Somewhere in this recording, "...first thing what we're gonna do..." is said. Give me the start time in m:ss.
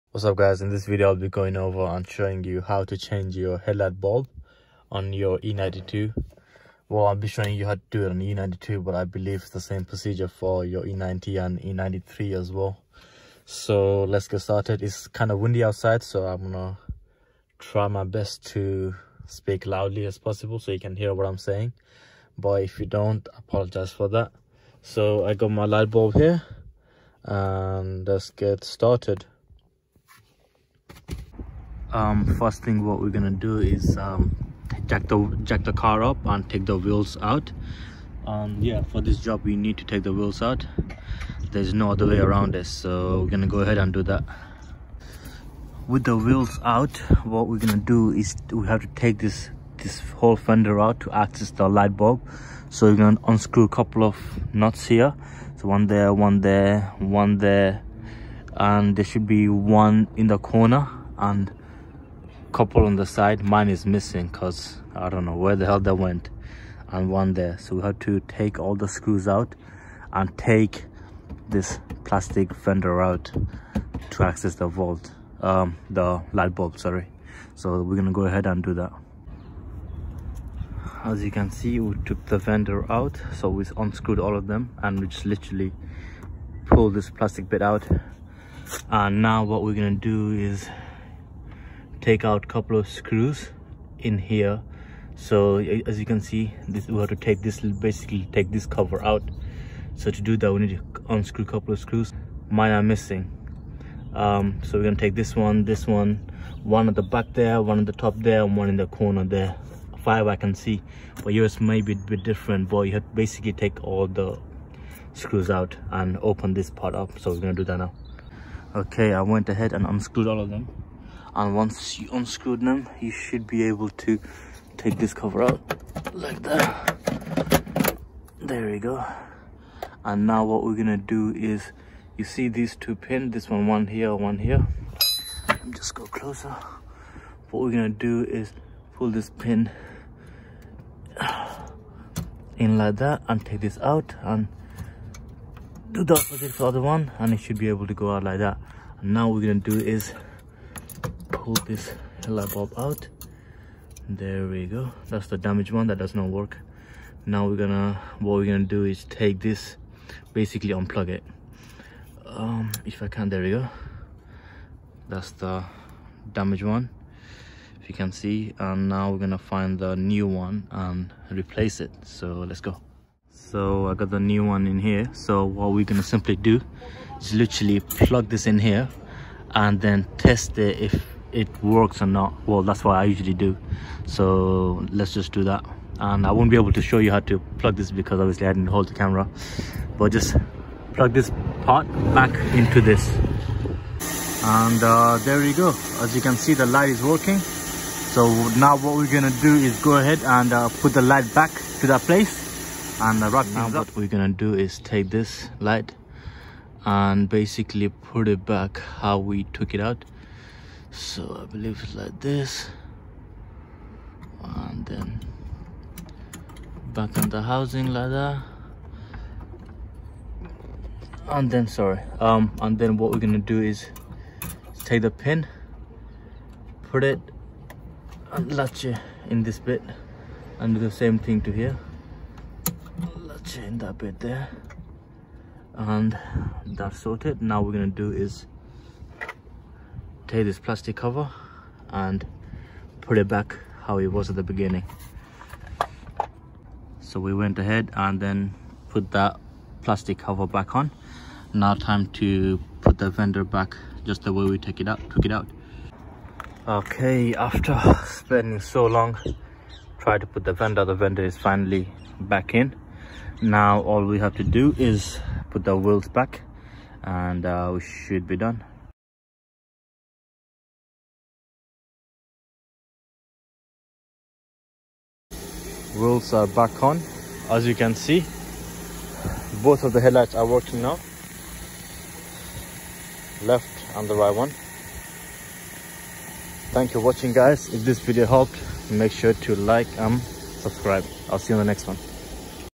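0:32.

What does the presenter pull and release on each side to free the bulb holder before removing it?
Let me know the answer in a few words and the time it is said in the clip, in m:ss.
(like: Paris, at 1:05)
pins, at 2:12.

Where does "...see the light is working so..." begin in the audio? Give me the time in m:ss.
3:16.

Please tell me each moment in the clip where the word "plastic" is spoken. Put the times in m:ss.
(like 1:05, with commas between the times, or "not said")
1:12, 1:27, 4:00, 4:09.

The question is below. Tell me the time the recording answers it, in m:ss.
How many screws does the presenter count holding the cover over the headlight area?
1:50.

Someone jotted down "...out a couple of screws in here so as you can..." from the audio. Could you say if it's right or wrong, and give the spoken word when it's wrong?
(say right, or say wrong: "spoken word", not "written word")
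right.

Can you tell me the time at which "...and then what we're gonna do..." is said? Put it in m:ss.
3:42.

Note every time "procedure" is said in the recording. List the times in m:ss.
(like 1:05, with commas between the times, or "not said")
0:09.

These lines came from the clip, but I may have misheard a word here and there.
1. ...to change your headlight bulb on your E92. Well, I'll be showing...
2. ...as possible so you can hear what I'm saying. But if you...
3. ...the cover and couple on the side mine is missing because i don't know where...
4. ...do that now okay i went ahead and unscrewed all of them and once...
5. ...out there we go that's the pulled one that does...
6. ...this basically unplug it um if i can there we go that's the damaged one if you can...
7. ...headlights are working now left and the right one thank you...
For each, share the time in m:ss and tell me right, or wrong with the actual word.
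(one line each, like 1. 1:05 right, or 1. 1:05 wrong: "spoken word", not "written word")
1. 0:02 right
2. 0:20 right
3. 1:00 wrong: "corner", not "cover"
4. 1:57 right
5. 2:32 wrong: "damaged", not "pulled"
6. 2:39 right
7. 4:39 right.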